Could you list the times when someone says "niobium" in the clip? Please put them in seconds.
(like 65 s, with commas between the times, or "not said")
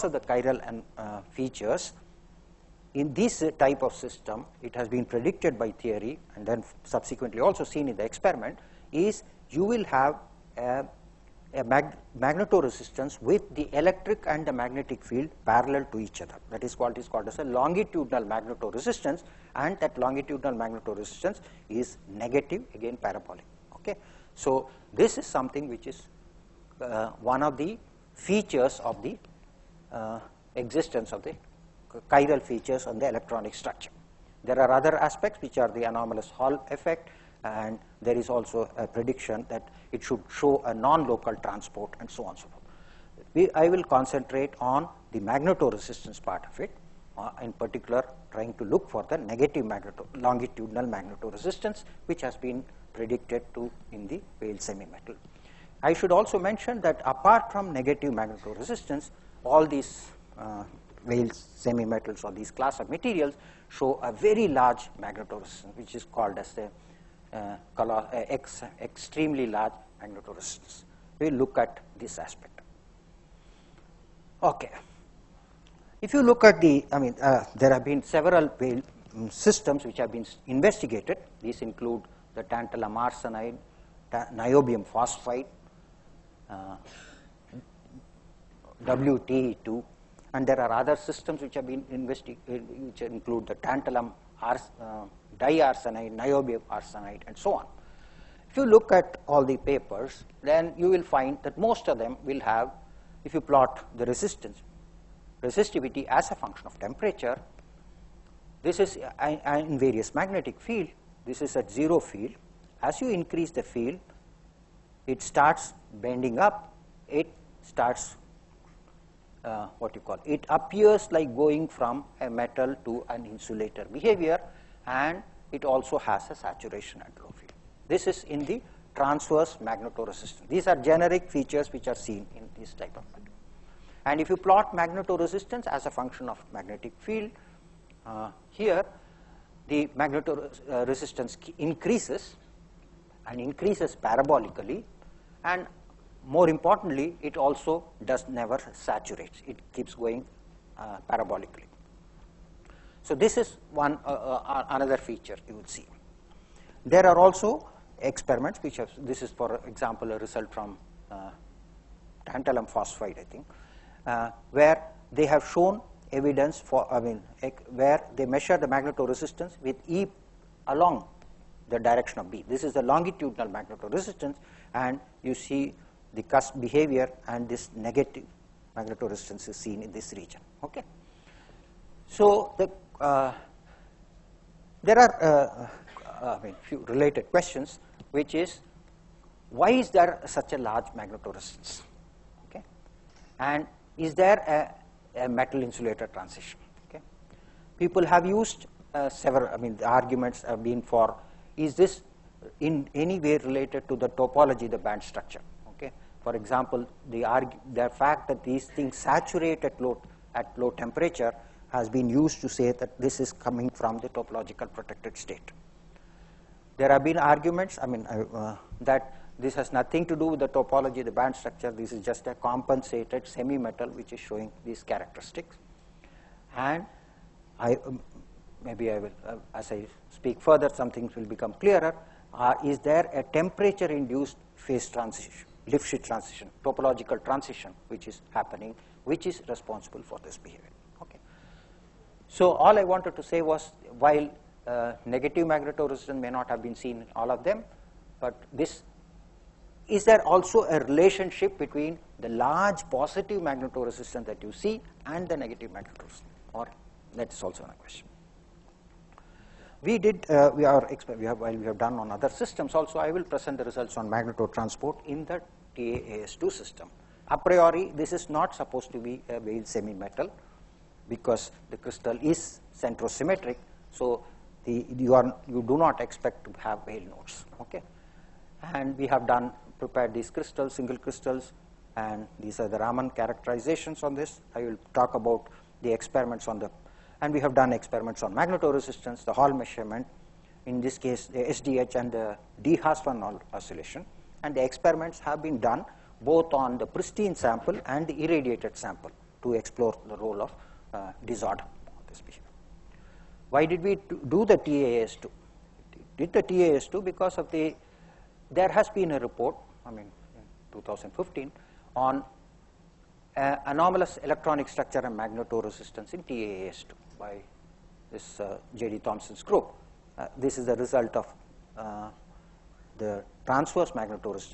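84 s, 96 s.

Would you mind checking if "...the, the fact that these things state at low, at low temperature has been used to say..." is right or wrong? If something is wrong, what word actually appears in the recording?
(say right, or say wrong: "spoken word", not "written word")
wrong: "saturate", not "state".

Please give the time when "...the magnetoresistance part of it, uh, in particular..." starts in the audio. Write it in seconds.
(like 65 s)
45 s.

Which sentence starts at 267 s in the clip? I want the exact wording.
A priori, this is not supposed to be a Weyl semi-metal because the crystal is centrosymmetric.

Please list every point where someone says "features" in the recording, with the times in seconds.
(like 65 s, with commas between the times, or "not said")
1 s, 28 s, 32 s, 131 s, 154 s.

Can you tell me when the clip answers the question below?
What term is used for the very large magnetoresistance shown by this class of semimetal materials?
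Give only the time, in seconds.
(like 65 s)
68 s.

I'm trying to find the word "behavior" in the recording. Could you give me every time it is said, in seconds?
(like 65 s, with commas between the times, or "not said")
123 s, 176 s, 240 s.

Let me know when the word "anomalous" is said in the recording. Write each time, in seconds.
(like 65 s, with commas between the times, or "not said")
35 s, 313 s.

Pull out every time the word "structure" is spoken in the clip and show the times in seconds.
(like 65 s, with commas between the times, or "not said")
33 s, 205 s, 221 s, 314 s.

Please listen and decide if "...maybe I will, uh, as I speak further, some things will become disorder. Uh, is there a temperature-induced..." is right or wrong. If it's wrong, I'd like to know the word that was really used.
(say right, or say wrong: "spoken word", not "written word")
wrong: "clearer", not "disorder".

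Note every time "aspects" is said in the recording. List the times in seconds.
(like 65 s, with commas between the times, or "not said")
34 s, 72 s.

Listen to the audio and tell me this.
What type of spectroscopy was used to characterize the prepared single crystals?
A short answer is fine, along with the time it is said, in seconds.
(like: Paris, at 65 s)
Raman, at 282 s.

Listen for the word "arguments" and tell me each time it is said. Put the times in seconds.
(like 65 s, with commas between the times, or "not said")
199 s, 217 s.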